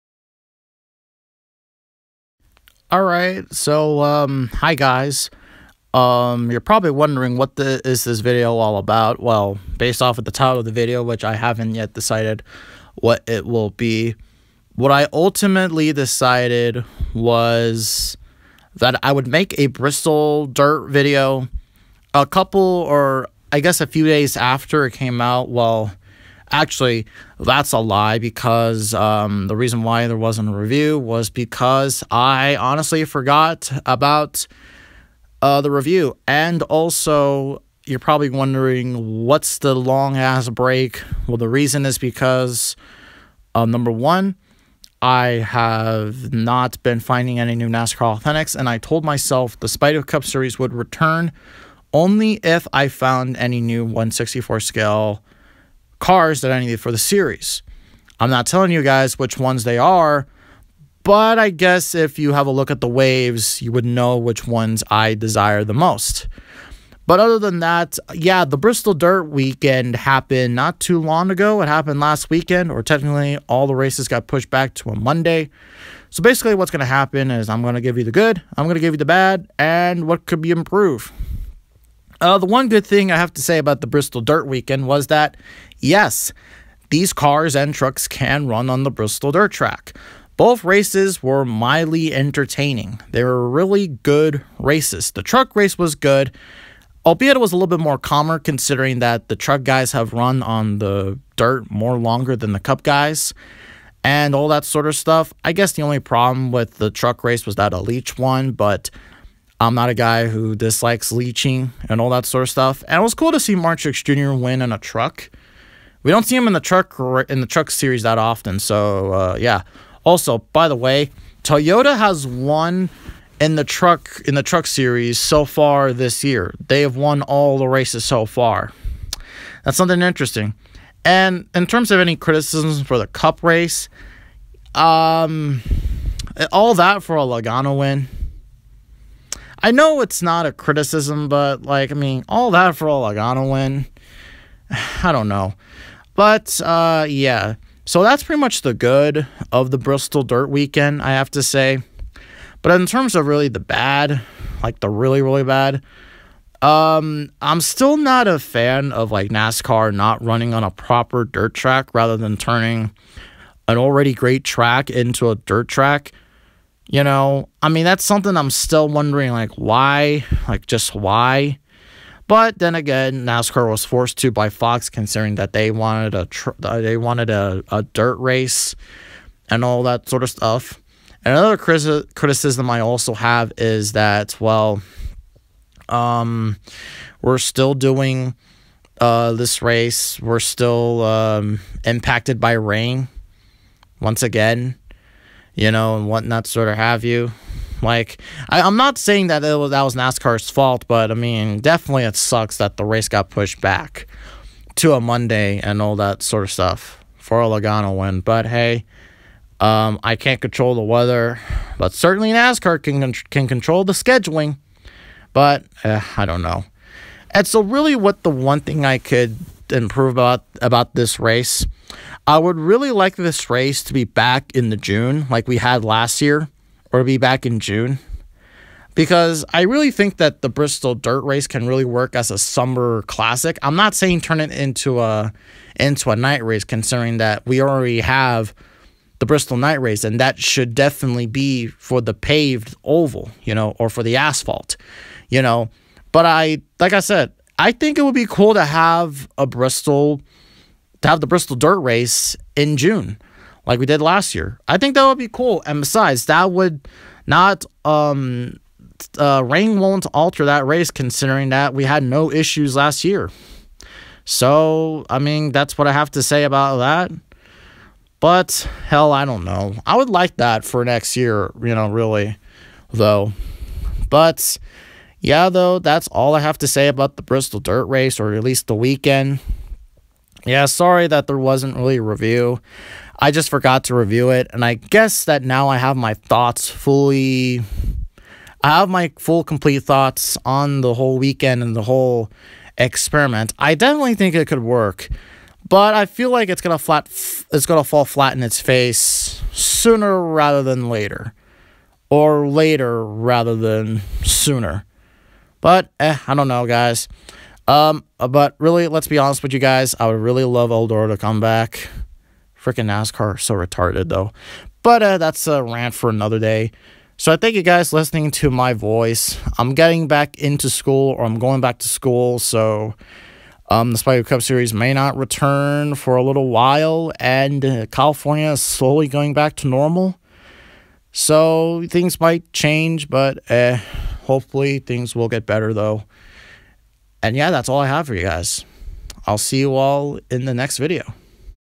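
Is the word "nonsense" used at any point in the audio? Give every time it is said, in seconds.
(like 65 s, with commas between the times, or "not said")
not said.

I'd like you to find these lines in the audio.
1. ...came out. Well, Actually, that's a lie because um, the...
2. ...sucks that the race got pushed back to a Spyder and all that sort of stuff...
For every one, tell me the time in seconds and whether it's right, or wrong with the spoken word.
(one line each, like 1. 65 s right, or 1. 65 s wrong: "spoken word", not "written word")
1. 24 s right
2. 202 s wrong: "Monday", not "Spyder".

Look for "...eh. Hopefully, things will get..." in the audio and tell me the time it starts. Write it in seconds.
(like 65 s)
333 s.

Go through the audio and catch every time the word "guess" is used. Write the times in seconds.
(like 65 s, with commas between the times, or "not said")
23 s, 61 s, 105 s, 284 s.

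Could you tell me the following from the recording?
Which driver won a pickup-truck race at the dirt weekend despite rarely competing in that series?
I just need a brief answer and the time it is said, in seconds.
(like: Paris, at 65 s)
Mark Jr., at 113 s.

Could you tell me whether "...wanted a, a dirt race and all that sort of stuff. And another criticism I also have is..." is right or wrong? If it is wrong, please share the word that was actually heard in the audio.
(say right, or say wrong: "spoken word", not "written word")
right.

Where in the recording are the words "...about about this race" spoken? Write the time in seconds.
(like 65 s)
220 s.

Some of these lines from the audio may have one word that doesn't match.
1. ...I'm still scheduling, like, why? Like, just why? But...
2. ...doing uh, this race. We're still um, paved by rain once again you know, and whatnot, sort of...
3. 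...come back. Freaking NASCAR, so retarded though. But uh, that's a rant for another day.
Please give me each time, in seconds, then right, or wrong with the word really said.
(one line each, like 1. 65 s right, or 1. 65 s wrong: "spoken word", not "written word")
1. 168 s wrong: "wondering", not "scheduling"
2. 187 s wrong: "impacted", not "paved"
3. 311 s right.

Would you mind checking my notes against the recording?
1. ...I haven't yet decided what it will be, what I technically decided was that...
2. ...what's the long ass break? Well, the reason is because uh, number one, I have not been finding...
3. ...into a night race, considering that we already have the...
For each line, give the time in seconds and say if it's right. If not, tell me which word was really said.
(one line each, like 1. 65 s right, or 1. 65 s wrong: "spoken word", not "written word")
1. 11 s wrong: "ultimately", not "technically"
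2. 39 s right
3. 235 s right.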